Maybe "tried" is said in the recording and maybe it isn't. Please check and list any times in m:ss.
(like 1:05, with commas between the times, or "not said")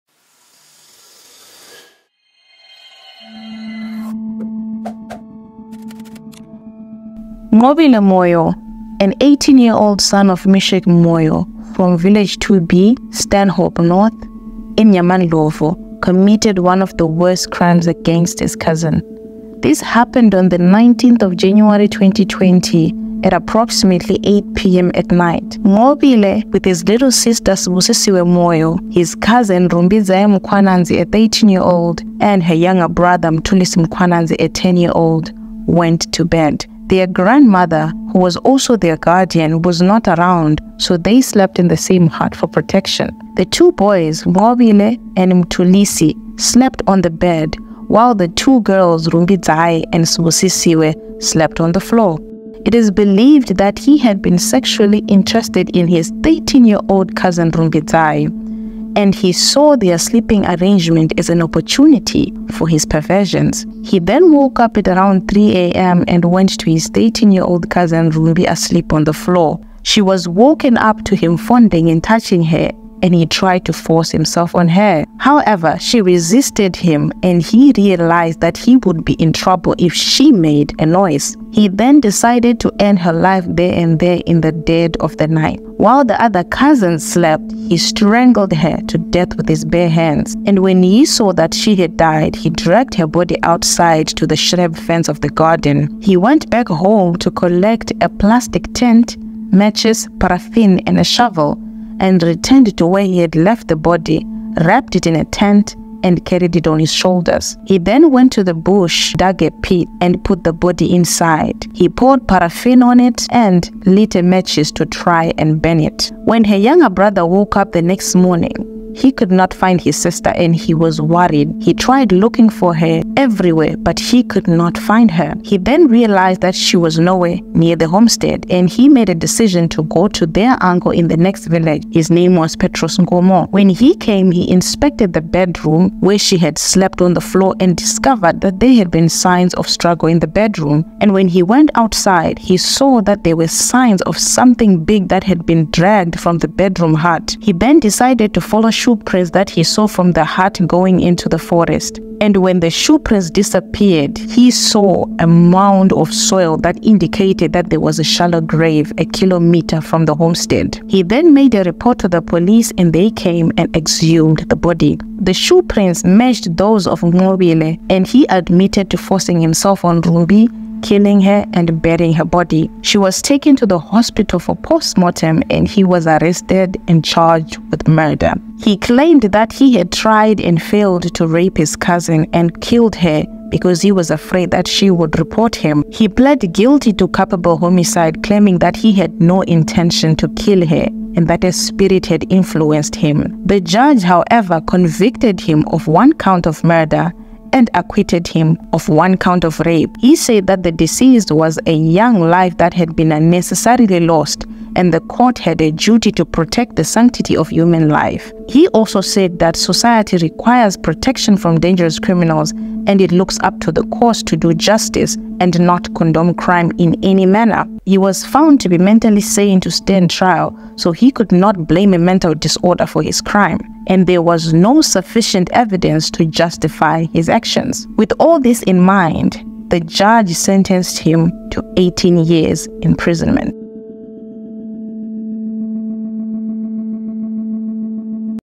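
1:13, 2:01, 2:59.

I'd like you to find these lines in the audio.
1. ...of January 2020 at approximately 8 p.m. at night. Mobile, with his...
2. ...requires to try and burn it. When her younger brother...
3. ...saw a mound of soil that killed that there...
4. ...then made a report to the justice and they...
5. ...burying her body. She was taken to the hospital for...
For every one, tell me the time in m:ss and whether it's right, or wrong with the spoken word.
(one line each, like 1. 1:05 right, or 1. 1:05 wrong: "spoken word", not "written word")
1. 0:21 right
2. 1:54 wrong: "matches", not "requires"
3. 2:34 wrong: "indicated", not "killed"
4. 2:41 wrong: "police", not "justice"
5. 2:51 right.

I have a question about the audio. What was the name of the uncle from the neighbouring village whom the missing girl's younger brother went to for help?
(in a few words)
Petros Ngomo.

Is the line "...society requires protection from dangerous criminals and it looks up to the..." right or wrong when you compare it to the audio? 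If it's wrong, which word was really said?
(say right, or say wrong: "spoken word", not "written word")
right.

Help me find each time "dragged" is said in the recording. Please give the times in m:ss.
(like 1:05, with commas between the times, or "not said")
1:32, 2:25.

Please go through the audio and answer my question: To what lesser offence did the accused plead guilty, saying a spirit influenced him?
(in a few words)
Culpable homicide.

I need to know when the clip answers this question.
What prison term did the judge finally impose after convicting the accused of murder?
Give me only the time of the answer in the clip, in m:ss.
3:51.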